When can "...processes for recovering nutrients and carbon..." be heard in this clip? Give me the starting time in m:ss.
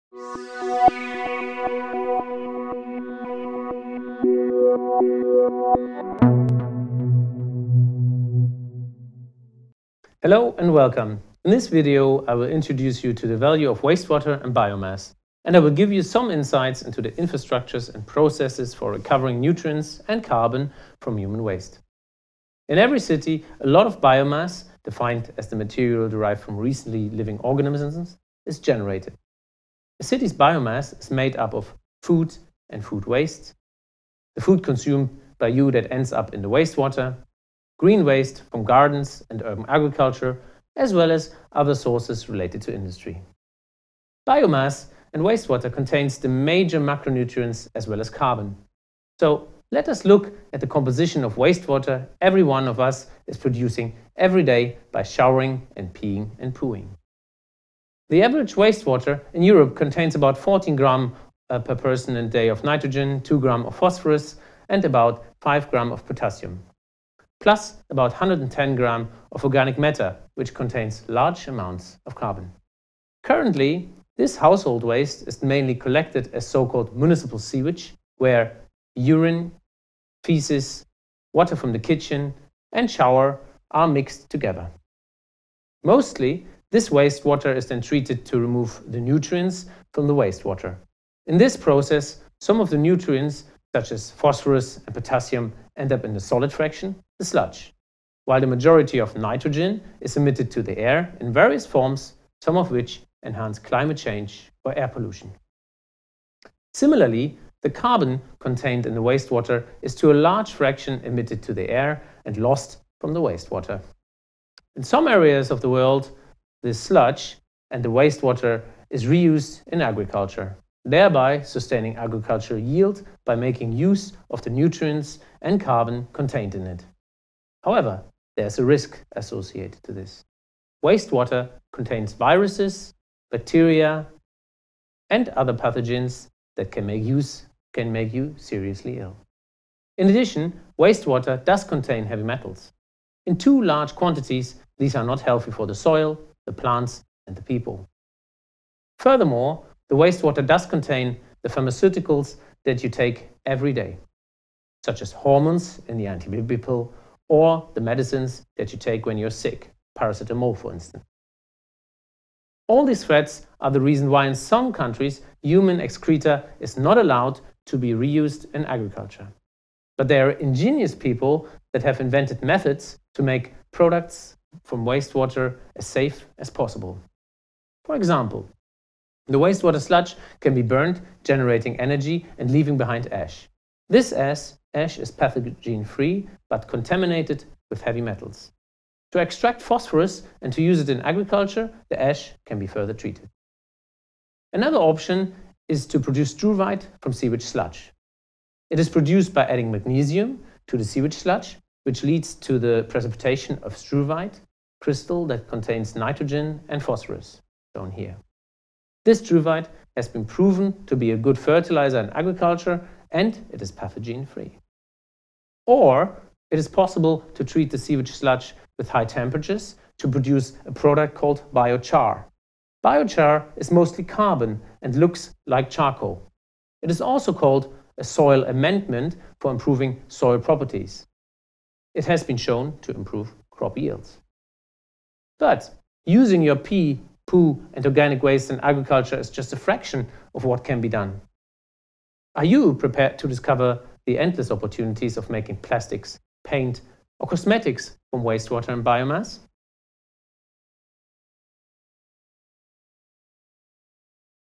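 0:18.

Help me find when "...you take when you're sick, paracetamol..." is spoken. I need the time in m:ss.
2:38.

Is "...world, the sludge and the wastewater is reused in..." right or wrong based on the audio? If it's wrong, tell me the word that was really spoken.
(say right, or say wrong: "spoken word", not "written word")
right.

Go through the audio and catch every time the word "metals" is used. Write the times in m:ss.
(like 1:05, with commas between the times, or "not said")
2:22, 3:08.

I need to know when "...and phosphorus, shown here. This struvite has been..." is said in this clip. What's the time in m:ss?
3:26.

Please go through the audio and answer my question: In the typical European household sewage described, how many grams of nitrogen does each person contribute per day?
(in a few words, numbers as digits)
14 grams.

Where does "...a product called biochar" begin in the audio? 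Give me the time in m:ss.
3:40.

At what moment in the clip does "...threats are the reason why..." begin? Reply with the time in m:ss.
2:43.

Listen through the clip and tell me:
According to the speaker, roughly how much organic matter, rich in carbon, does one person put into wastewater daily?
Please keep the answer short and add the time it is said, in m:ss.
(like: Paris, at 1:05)
110 grams, at 1:08.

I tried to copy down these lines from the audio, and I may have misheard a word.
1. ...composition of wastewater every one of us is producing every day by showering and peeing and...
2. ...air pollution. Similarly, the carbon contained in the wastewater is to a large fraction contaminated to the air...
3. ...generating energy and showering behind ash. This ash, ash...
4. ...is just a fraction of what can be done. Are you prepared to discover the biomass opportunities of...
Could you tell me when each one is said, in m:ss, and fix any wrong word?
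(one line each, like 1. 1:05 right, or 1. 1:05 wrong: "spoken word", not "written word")
1. 0:50 right
2. 1:44 wrong: "emitted", not "contaminated"
3. 3:01 wrong: "leaving", not "showering"
4. 3:59 wrong: "endless", not "biomass".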